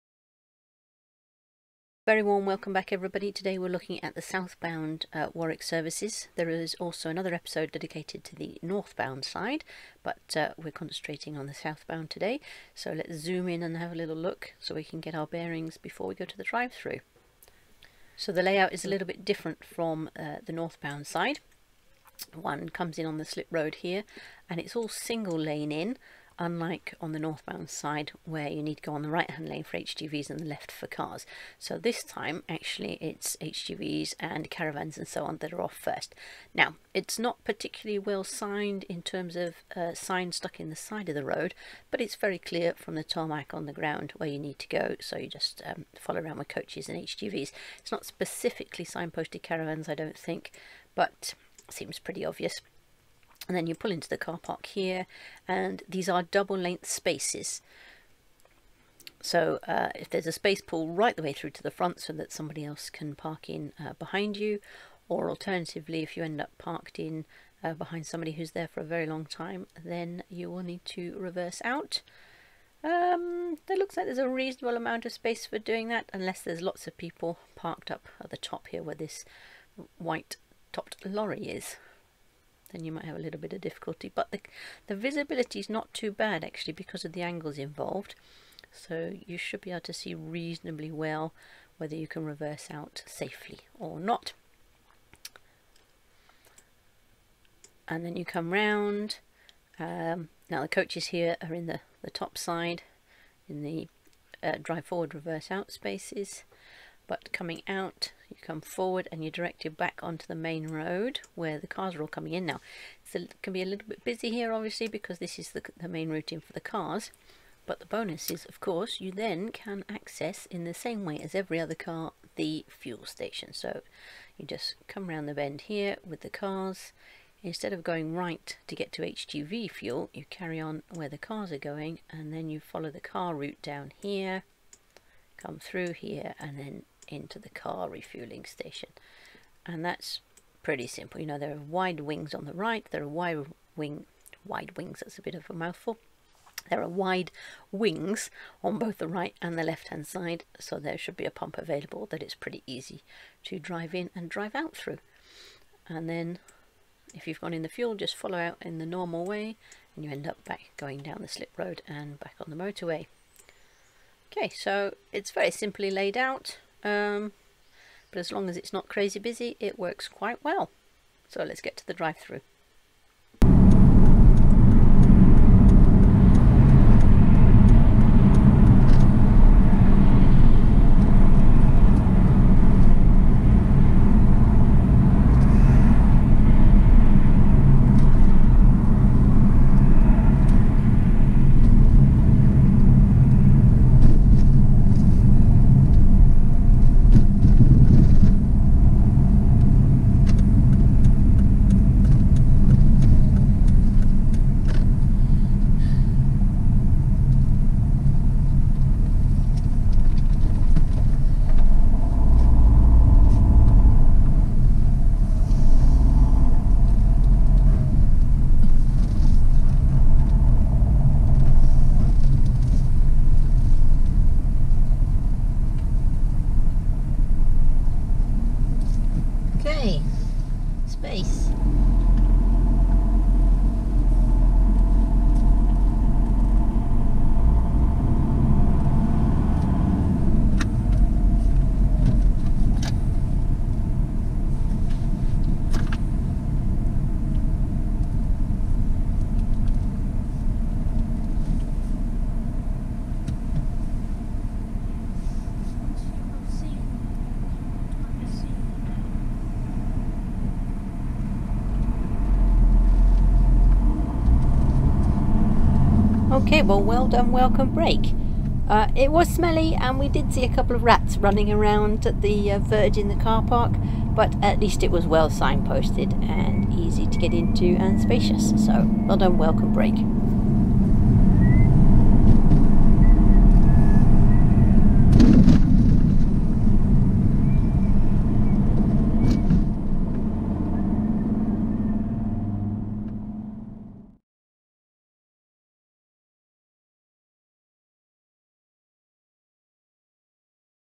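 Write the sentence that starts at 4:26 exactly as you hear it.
Okay, well, well done, welcome break.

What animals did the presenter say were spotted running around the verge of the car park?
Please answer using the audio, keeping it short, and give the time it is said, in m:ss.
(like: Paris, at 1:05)
Rats, at 4:30.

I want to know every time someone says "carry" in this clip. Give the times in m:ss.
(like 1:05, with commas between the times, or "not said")
2:10.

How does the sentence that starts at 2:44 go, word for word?
Okay, so it's very simply laid out.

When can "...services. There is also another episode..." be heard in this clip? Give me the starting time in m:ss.
0:05.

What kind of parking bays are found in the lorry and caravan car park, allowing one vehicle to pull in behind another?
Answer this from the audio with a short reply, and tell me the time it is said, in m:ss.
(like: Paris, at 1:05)
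Double length spaces, at 0:56.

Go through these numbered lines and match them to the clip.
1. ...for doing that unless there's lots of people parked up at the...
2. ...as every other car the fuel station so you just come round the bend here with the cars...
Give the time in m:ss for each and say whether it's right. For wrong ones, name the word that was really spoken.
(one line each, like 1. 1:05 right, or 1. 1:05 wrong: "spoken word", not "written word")
1. 1:15 right
2. 2:01 right.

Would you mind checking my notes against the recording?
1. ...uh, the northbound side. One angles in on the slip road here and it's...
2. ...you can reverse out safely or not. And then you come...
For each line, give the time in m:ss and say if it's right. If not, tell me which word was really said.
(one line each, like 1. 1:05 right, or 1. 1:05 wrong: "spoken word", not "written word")
1. 0:20 wrong: "comes", not "angles"
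2. 1:31 right.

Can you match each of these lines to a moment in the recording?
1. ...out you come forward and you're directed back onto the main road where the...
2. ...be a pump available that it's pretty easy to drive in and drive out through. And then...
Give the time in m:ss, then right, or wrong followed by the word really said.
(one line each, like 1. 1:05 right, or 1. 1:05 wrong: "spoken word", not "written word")
1. 1:47 right
2. 2:31 right.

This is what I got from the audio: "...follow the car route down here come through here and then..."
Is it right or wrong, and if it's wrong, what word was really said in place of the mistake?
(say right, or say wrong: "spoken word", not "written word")
right.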